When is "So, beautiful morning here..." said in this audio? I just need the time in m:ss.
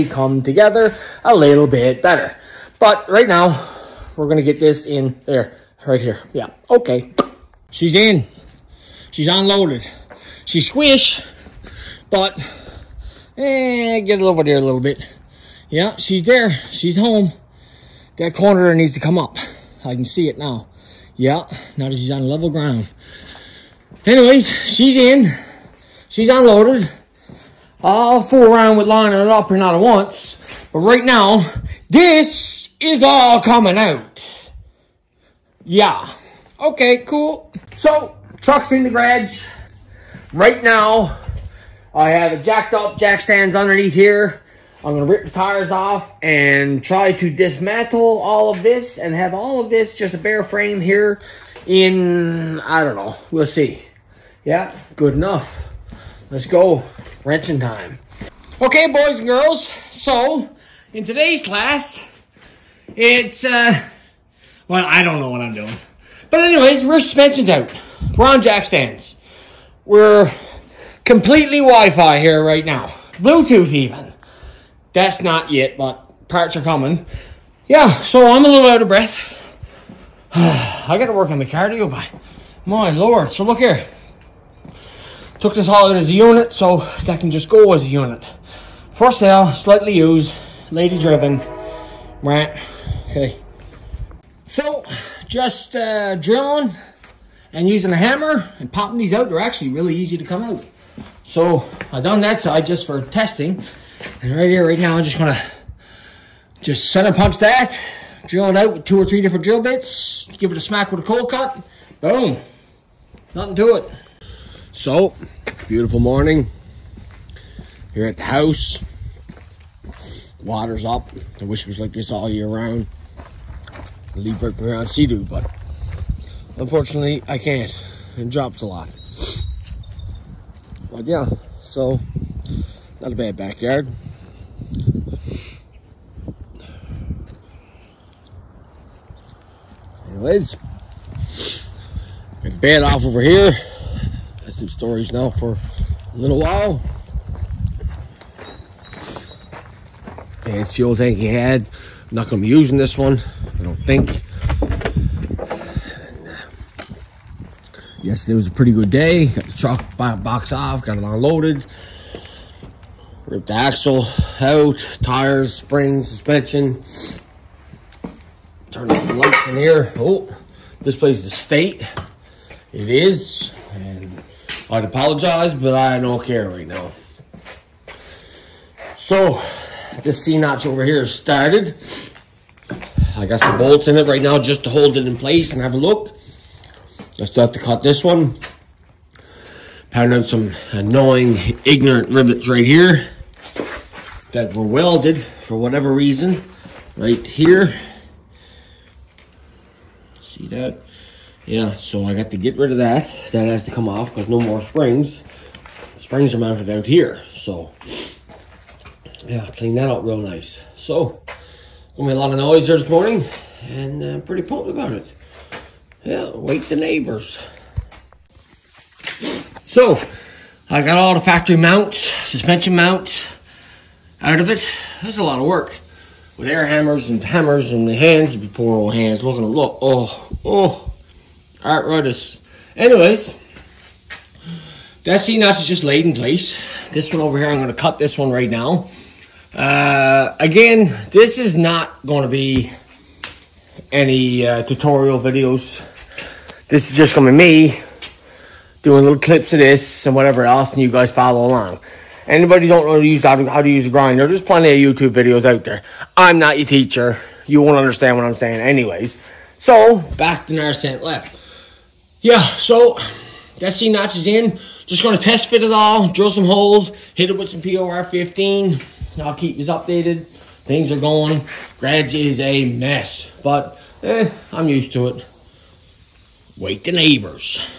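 1:54.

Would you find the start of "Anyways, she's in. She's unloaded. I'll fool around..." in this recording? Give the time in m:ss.
0:24.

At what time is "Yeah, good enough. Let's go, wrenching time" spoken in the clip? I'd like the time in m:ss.
0:54.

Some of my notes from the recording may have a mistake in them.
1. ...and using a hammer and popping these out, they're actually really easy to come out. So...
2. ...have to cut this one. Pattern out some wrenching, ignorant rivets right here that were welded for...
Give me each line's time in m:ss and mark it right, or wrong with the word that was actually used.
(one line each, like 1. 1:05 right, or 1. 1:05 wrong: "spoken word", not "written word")
1. 1:37 right
2. 3:07 wrong: "annoying", not "wrenching".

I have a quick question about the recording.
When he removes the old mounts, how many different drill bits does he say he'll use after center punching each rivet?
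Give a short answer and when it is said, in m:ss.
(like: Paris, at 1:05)
2 or 3, at 1:48.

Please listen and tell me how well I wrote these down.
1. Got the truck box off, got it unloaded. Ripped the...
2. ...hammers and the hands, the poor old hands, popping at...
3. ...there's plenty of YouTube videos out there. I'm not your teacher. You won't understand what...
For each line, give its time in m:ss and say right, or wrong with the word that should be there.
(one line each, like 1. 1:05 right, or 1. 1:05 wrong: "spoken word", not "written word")
1. 2:39 right
2. 3:47 wrong: "looking", not "popping"
3. 4:14 right.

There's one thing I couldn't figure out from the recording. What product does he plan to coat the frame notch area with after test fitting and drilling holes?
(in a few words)
POR15.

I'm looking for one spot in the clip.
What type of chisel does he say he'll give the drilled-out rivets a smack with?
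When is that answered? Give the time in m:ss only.
1:51.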